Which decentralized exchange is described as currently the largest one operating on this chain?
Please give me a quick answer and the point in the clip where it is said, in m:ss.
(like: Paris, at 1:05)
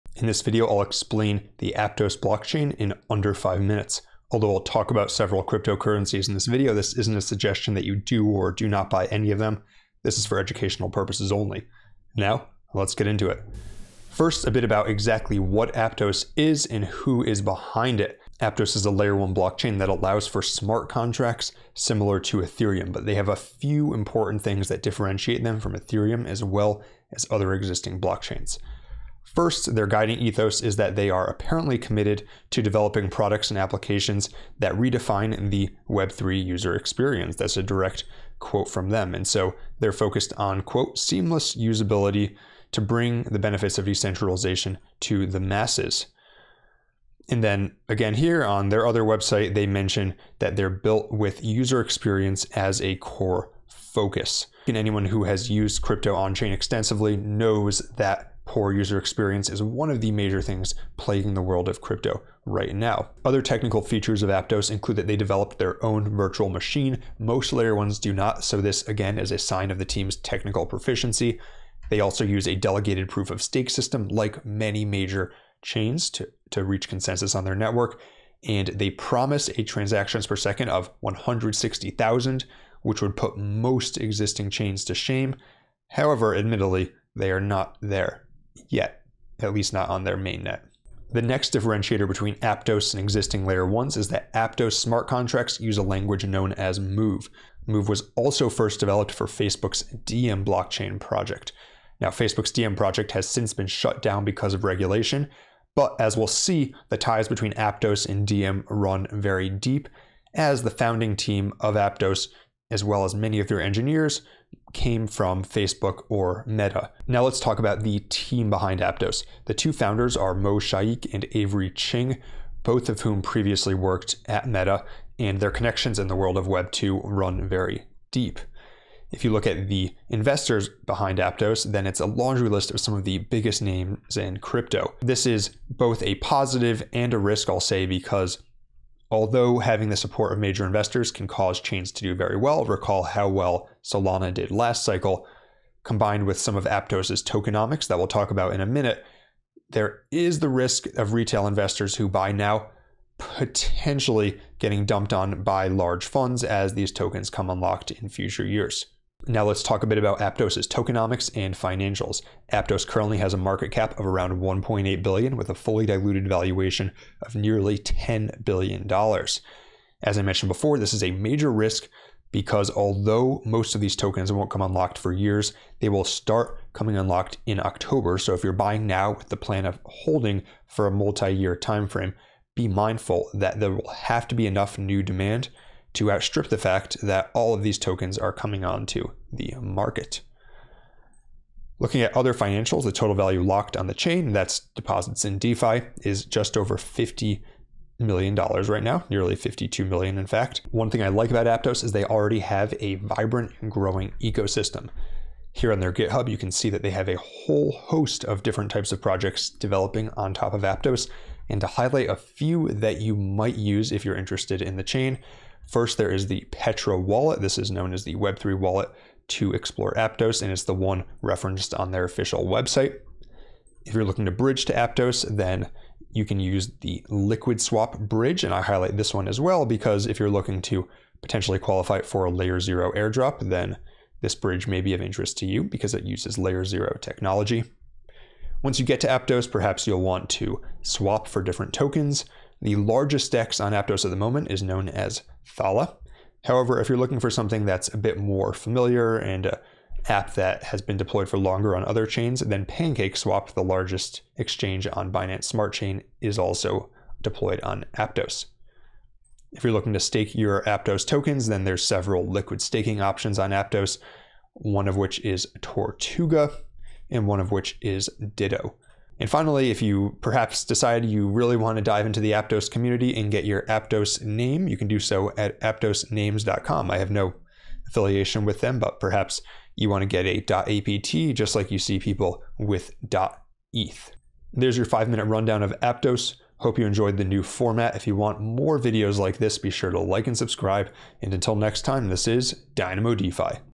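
Thala, at 4:05.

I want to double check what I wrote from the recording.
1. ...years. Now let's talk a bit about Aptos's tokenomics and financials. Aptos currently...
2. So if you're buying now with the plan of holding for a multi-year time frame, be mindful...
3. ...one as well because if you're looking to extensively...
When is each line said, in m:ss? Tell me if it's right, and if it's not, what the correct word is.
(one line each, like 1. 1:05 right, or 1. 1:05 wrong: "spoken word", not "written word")
1. 2:38 right
2. 2:58 right
3. 3:49 wrong: "potentially", not "extensively".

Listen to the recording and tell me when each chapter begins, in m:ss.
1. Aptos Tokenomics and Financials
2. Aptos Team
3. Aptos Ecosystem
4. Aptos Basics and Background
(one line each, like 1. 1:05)
1. 2:39
2. 1:57
3. 3:20
4. 0:14.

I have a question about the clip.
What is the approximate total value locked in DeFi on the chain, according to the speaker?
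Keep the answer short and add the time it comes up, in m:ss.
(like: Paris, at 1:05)
nearly $52 million, at 3:19.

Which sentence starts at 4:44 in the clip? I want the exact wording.
There's your five minute rundown of Aptos.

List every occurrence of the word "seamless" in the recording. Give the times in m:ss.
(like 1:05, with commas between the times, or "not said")
0:40.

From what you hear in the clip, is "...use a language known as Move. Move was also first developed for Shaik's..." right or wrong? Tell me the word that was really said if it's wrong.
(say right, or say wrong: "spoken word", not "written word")
wrong: "Facebook", not "Shaik".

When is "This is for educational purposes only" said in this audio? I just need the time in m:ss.
0:10.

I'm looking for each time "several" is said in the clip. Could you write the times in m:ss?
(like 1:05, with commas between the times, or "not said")
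0:05, 4:21.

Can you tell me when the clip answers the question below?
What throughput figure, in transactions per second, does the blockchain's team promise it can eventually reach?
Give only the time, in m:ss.
1:20.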